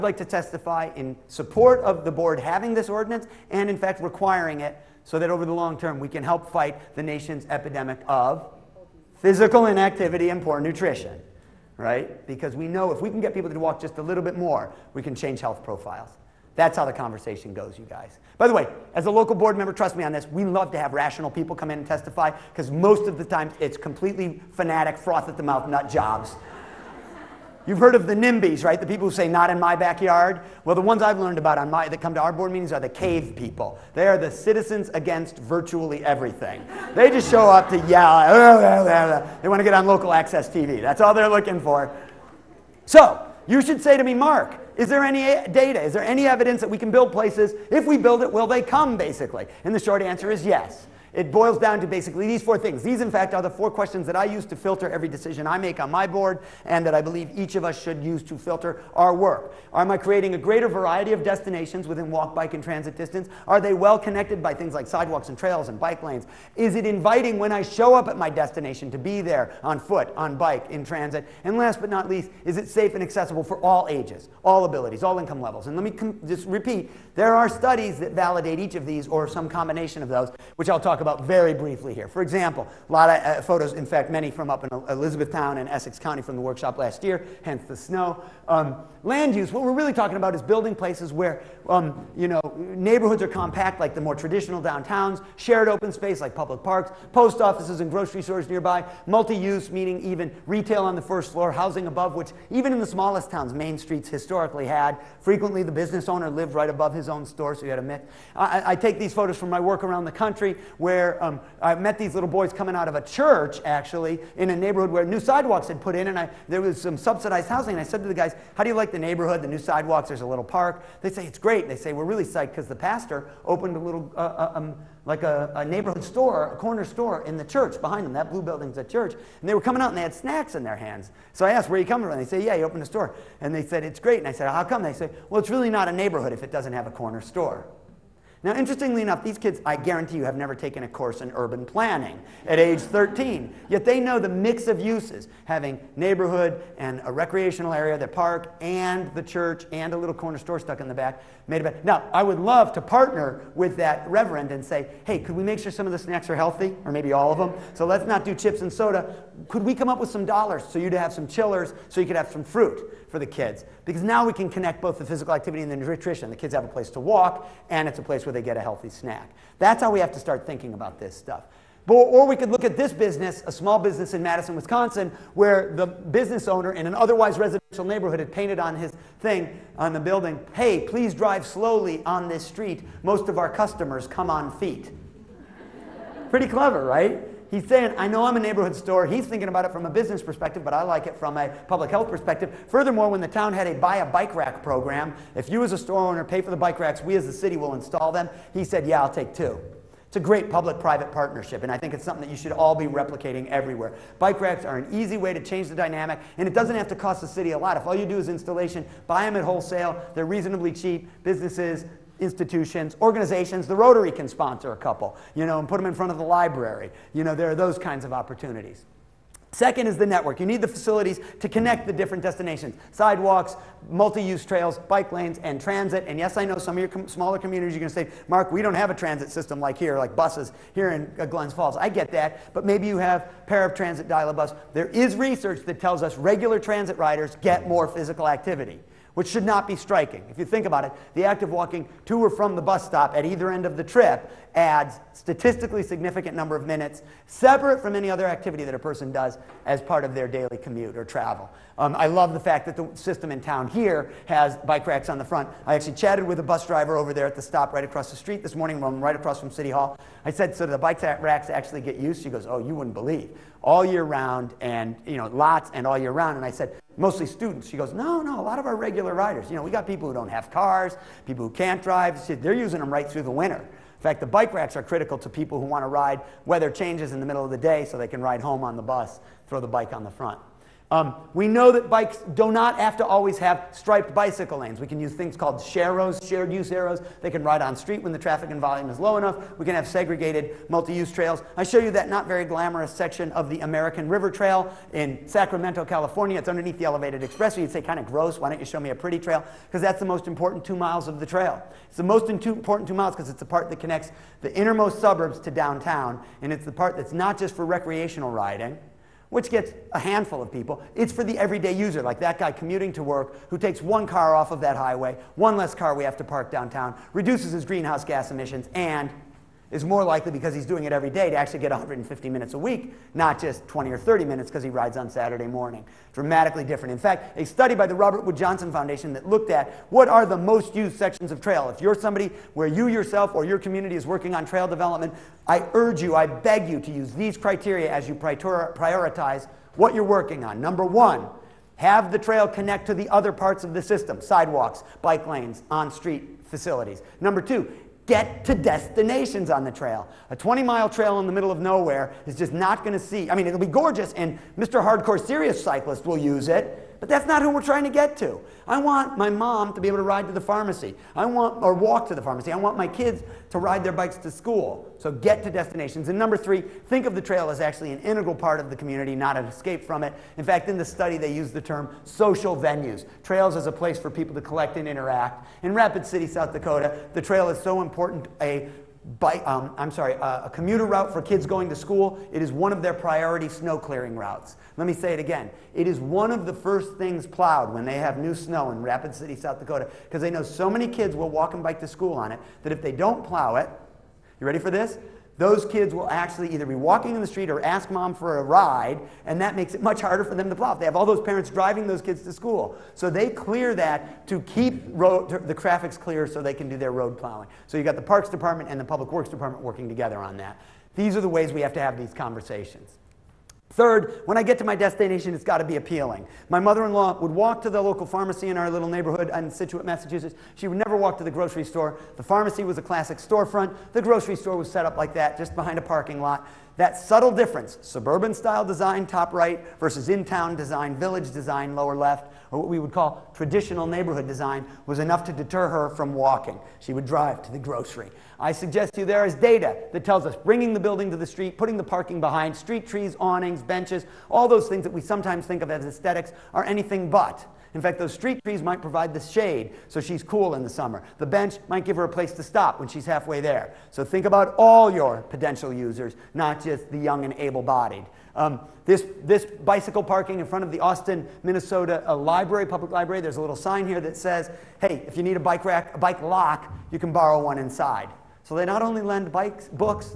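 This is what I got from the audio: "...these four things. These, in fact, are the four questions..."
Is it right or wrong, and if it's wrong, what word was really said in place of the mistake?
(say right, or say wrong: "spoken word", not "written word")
right.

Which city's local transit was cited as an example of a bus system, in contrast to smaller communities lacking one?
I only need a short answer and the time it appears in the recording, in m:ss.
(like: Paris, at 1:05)
Glens Falls, at 3:51.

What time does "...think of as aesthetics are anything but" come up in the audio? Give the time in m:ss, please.
7:25.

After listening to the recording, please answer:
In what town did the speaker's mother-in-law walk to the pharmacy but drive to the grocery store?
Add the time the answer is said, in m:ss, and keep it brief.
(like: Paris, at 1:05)
Scituate, Massachusetts, at 6:59.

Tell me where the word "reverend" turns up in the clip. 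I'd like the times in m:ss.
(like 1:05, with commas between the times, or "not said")
2:34.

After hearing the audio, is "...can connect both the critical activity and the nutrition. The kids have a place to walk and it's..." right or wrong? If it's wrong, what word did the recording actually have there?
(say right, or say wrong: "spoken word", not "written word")
wrong: "physical", not "critical".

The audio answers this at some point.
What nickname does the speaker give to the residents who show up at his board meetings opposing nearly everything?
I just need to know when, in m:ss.
0:32.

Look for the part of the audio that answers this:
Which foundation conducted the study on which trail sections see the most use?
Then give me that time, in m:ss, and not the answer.
5:27.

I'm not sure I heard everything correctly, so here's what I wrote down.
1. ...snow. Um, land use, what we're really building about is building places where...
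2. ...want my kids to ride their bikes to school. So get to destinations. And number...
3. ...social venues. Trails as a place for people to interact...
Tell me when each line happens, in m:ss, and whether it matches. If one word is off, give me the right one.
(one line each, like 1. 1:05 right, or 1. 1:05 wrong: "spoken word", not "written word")
1. 1:27 wrong: "talking", not "building"
2. 6:02 right
3. 6:12 wrong: "collect", not "interact".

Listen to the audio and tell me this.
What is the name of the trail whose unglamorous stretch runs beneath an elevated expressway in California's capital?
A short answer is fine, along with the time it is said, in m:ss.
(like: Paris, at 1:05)
American River Trail, at 4:53.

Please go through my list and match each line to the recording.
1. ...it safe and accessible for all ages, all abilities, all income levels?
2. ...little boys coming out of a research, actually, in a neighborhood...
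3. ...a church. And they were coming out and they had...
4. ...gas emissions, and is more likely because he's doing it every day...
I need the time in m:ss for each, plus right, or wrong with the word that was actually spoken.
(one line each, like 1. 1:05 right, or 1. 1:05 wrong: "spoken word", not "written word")
1. 1:12 right
2. 1:52 wrong: "church", not "research"
3. 2:08 right
4. 5:18 right.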